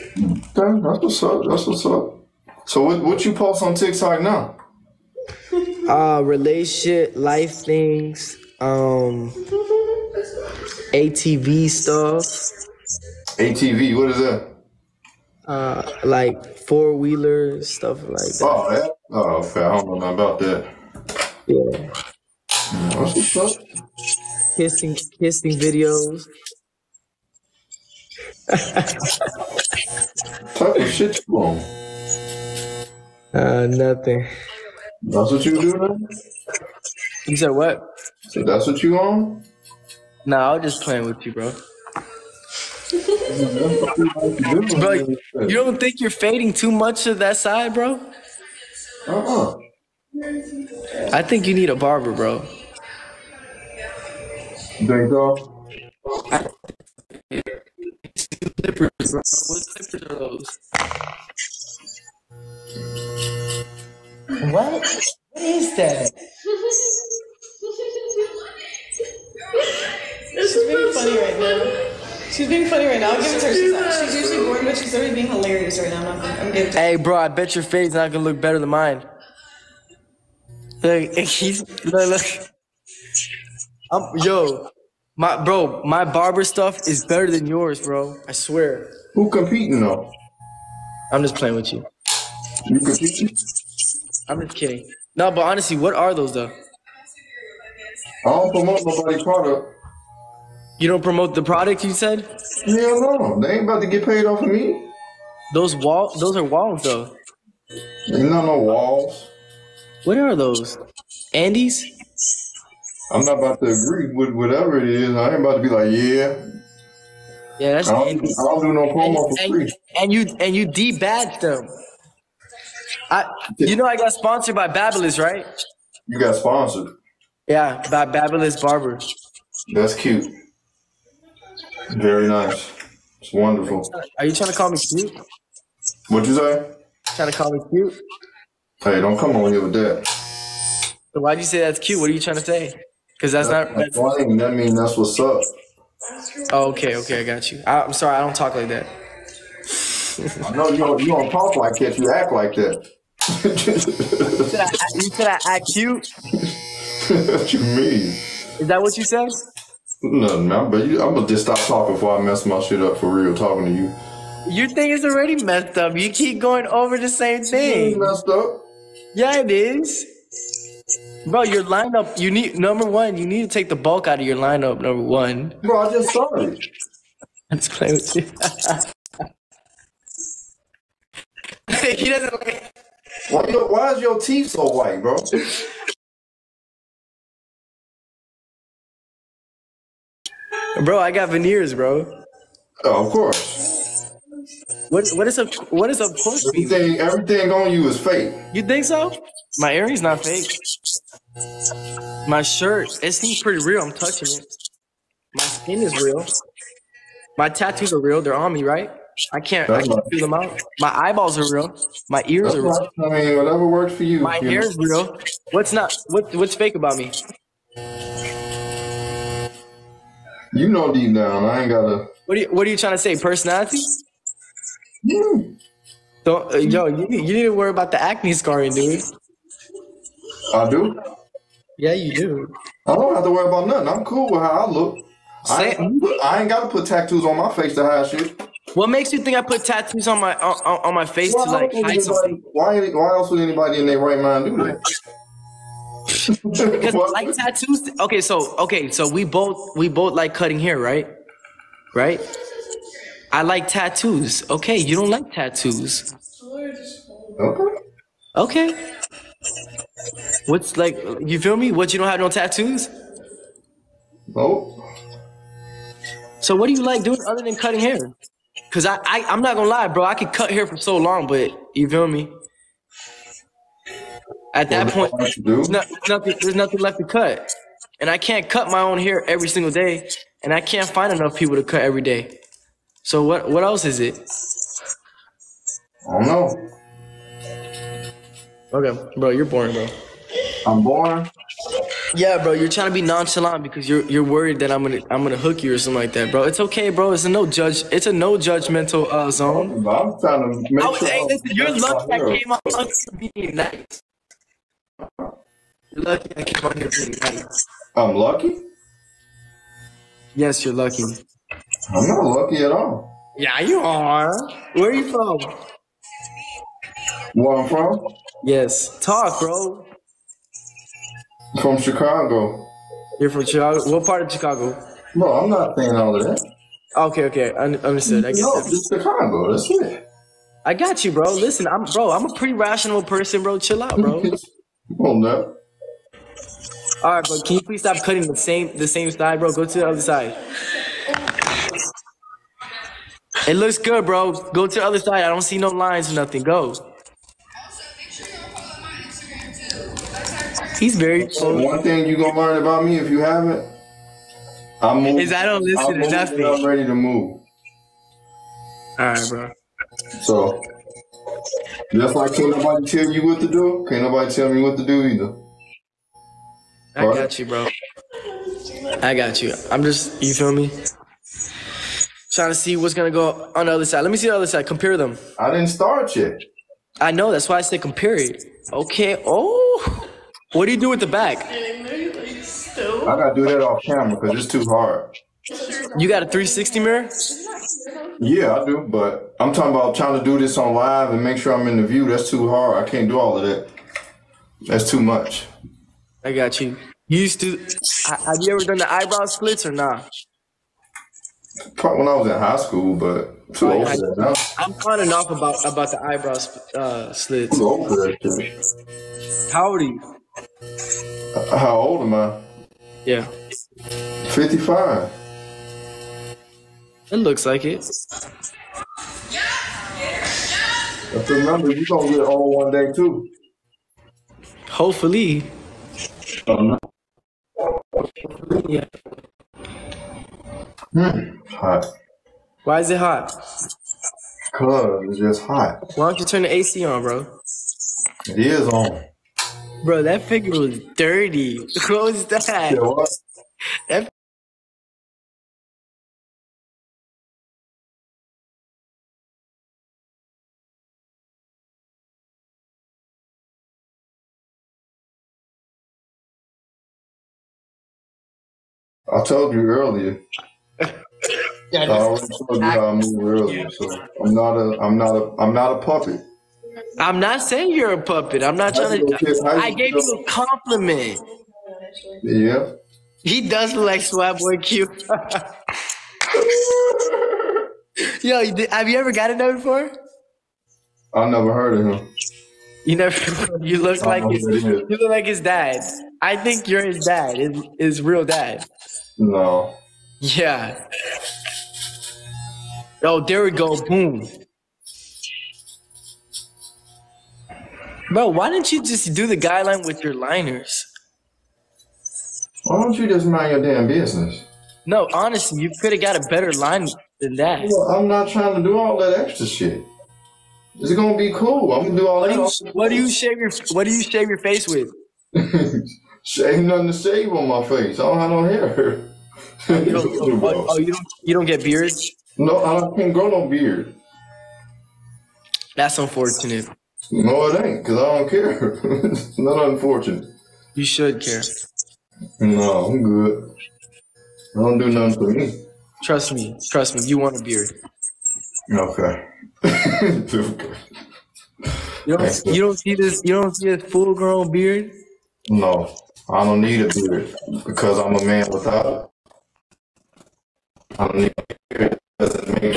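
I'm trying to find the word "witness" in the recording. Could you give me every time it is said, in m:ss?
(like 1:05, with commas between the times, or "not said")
not said.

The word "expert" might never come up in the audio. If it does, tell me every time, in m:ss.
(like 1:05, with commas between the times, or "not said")
not said.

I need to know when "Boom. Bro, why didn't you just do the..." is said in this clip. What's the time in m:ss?
8:13.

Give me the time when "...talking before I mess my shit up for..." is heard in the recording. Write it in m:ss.
2:41.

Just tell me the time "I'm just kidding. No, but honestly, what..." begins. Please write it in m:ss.
1:34.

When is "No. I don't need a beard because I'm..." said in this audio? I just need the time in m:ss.
9:05.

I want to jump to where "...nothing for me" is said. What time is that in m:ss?
8:54.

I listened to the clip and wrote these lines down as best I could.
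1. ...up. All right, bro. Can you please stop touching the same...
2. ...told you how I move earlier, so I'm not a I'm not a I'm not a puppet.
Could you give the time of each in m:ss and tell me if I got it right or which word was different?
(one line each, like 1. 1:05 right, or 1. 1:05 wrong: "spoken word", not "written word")
1. 5:35 wrong: "cutting", not "touching"
2. 7:42 right.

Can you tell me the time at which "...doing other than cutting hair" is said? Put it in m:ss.
4:27.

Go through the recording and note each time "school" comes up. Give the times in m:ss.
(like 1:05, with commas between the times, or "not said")
6:42.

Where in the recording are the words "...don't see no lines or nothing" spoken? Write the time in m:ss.
5:45.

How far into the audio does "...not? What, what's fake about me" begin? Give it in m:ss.
3:35.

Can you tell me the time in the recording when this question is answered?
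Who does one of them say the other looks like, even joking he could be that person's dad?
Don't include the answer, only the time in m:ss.
7:54.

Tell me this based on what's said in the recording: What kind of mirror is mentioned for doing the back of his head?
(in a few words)
360 mirror.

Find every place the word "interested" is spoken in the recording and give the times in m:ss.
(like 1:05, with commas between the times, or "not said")
not said.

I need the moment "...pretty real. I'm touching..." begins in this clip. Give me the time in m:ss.
3:23.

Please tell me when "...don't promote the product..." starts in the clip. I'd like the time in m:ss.
1:40.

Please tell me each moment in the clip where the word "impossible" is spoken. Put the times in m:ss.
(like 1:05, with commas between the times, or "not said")
not said.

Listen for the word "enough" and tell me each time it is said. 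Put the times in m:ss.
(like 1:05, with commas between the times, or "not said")
4:41.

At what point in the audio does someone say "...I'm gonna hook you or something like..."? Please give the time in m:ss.
4:55.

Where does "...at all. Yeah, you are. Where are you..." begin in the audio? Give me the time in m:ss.
5:12.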